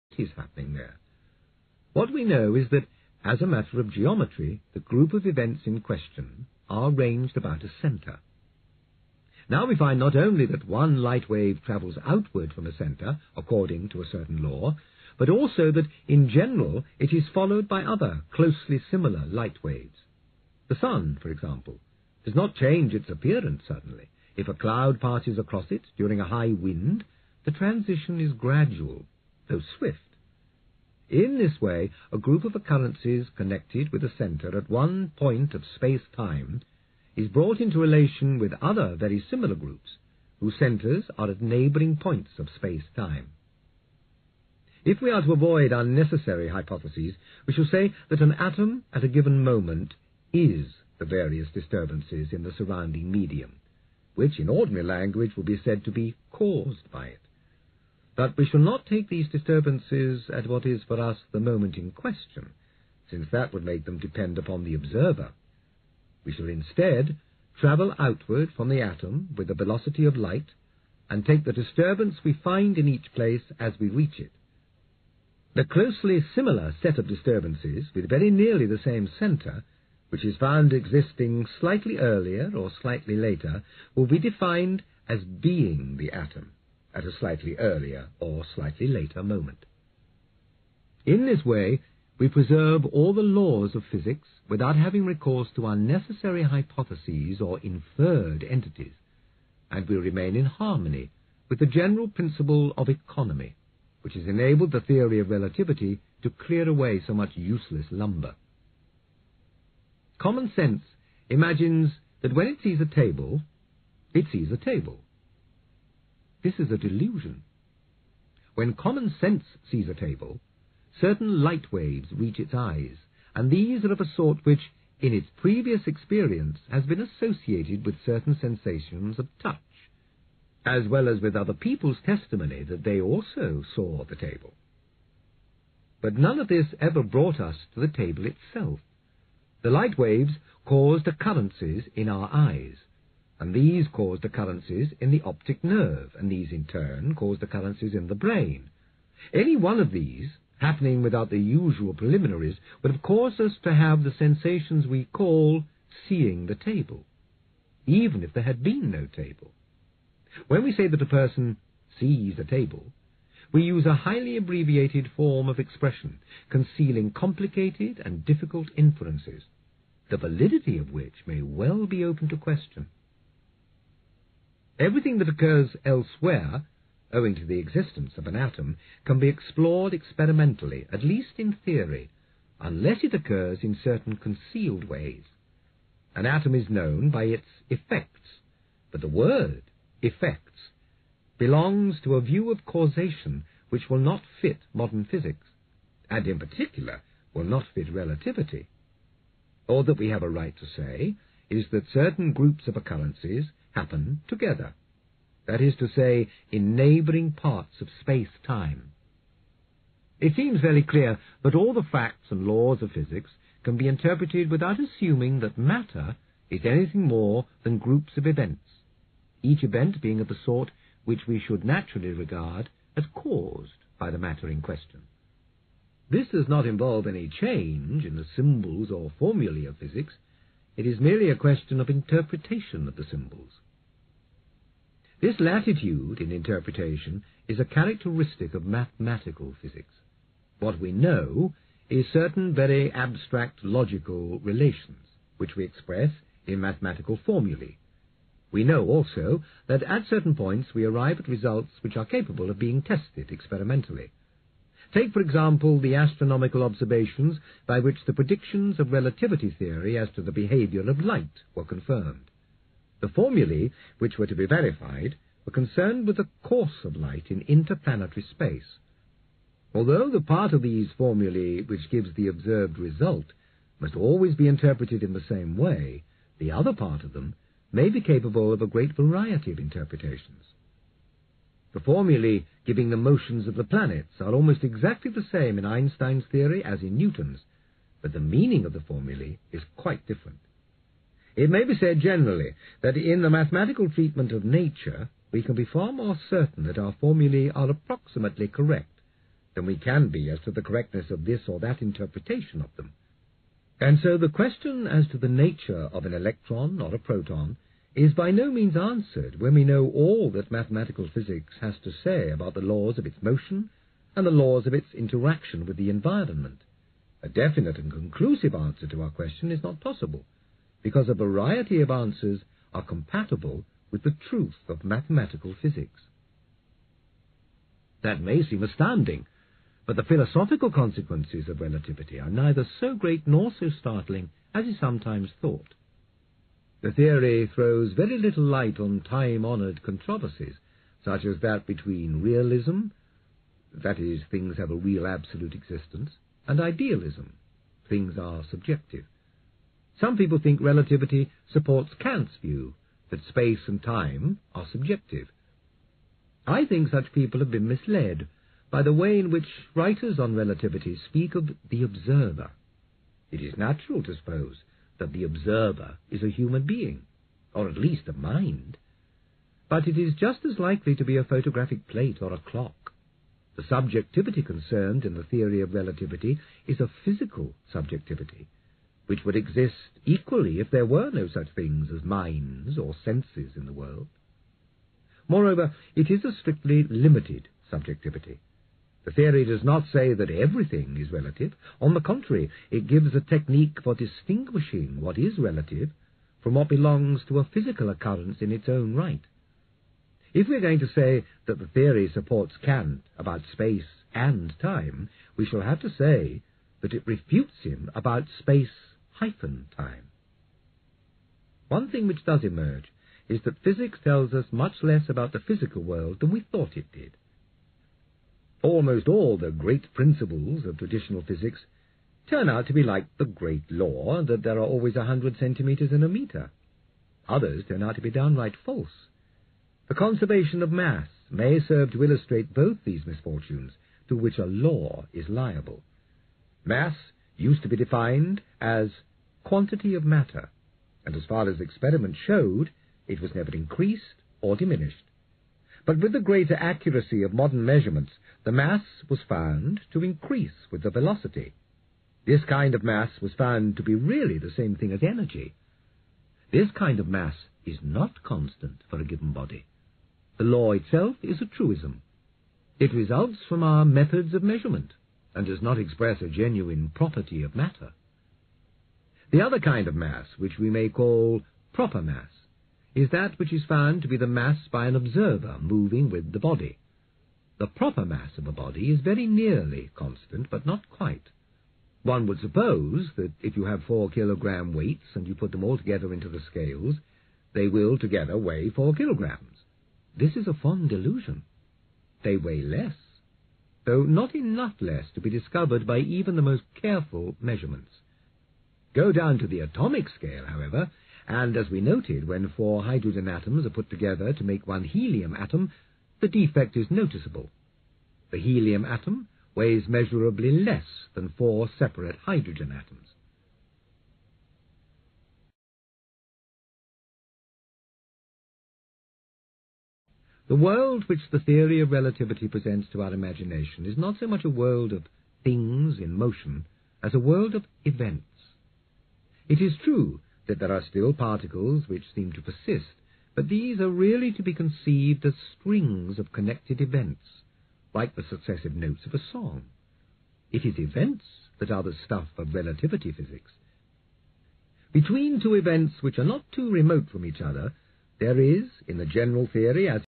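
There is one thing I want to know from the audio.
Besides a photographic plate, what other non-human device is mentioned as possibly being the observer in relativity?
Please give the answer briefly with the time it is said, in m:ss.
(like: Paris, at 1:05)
A clock, at 6:12.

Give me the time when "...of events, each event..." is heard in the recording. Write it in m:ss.
3:38.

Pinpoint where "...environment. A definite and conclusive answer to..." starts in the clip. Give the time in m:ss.
5:15.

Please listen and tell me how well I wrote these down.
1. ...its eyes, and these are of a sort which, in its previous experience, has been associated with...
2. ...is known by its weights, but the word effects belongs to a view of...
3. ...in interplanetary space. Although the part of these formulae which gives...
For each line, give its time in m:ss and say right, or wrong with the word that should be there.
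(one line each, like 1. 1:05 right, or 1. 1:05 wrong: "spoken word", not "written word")
1. 2:02 right
2. 3:06 wrong: "effects", not "weights"
3. 4:27 right.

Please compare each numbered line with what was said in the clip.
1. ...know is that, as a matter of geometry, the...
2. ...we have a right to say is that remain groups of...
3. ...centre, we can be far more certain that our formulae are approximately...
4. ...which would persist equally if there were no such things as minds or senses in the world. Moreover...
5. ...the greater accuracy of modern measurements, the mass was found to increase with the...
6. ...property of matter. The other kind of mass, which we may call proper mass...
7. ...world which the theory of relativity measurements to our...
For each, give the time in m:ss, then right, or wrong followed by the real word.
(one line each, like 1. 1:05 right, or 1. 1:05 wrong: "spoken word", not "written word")
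1. 0:02 right
2. 3:19 wrong: "certain", not "remain"
3. 4:54 wrong: "nature", not "centre"
4. 6:19 wrong: "exist", not "persist"
5. 7:26 right
6. 7:46 right
7. 8:40 wrong: "presents", not "measurements".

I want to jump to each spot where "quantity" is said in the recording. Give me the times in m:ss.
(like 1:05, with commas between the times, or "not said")
7:19.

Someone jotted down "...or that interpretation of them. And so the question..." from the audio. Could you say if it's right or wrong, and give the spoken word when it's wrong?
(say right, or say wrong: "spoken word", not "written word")
right.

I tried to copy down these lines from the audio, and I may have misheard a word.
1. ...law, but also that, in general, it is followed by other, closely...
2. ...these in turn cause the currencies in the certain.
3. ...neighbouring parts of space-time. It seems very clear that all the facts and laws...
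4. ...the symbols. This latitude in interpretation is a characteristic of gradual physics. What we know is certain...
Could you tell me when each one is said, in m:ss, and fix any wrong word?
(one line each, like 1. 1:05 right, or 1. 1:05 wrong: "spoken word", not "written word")
1. 0:14 right
2. 2:26 wrong: "brain", not "certain"
3. 3:26 right
4. 3:52 wrong: "mathematical", not "gradual".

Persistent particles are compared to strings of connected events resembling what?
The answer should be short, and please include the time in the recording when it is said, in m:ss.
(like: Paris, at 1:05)
Successive notes of a song, at 8:58.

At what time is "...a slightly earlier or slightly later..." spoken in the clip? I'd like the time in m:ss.
1:27.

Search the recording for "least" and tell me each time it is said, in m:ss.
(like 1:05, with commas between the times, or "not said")
3:01, 6:07.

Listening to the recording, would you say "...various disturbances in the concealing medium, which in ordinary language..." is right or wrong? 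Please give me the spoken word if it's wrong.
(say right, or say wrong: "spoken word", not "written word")
wrong: "surrounding", not "concealing".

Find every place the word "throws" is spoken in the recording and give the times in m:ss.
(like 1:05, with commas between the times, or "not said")
5:37.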